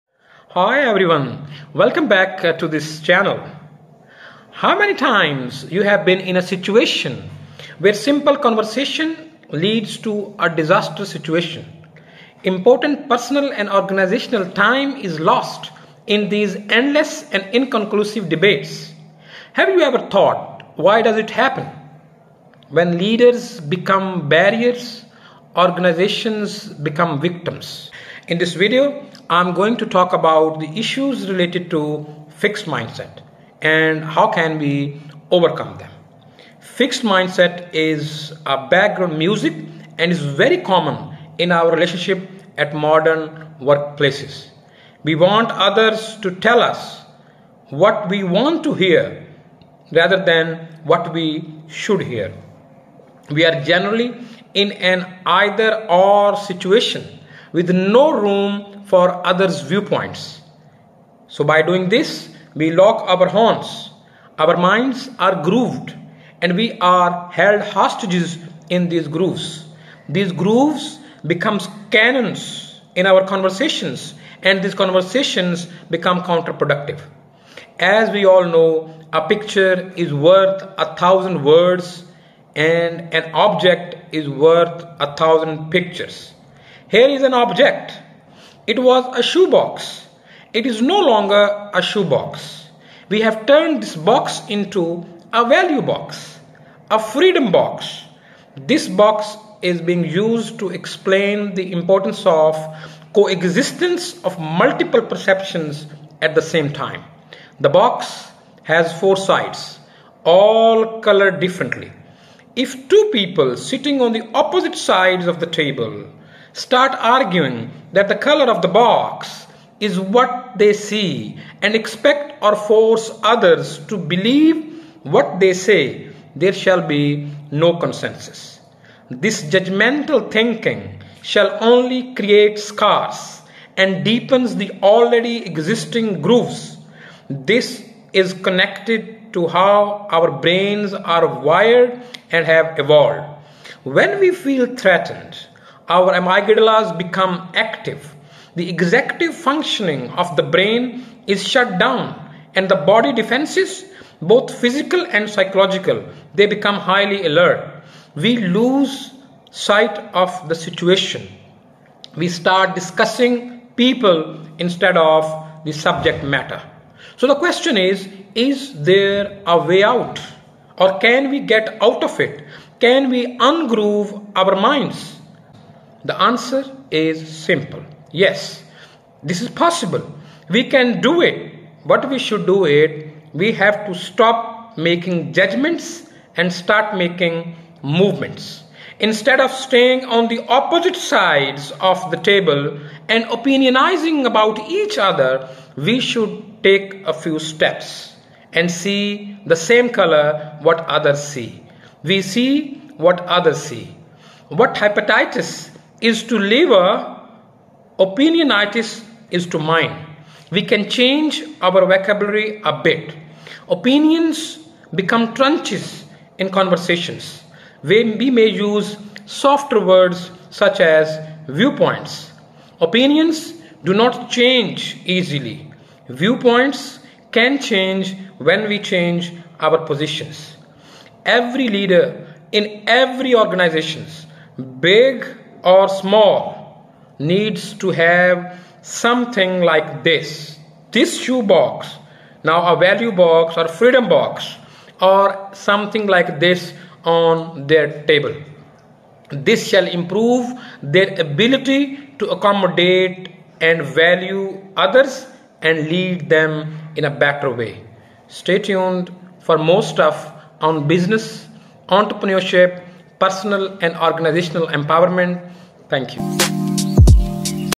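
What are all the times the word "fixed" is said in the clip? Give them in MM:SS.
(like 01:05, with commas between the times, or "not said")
00:32, 00:36.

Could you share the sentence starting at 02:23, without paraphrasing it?
When we feel threatened, our amygdalas become active.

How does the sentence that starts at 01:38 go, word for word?
This box is being used to explain the importance of coexistence of multiple perceptions at the same time.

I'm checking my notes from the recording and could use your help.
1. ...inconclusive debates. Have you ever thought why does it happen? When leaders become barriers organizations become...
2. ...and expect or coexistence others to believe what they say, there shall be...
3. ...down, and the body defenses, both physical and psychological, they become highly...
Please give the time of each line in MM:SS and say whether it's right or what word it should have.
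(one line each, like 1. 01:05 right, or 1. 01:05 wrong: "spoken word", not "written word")
1. 00:17 right
2. 02:01 wrong: "force", not "coexistence"
3. 02:31 right.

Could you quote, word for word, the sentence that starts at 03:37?
We may use softer words such as viewpoints.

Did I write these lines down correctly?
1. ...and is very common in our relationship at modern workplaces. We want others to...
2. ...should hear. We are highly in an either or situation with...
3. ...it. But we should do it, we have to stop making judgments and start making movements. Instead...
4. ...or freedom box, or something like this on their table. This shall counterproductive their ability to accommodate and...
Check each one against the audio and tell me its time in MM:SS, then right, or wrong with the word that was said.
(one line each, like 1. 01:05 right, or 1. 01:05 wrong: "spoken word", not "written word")
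1. 00:39 right
2. 00:51 wrong: "generally", not "highly"
3. 03:01 right
4. 04:03 wrong: "improve", not "counterproductive".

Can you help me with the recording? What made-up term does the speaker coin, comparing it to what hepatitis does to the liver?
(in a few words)
Opinionitis.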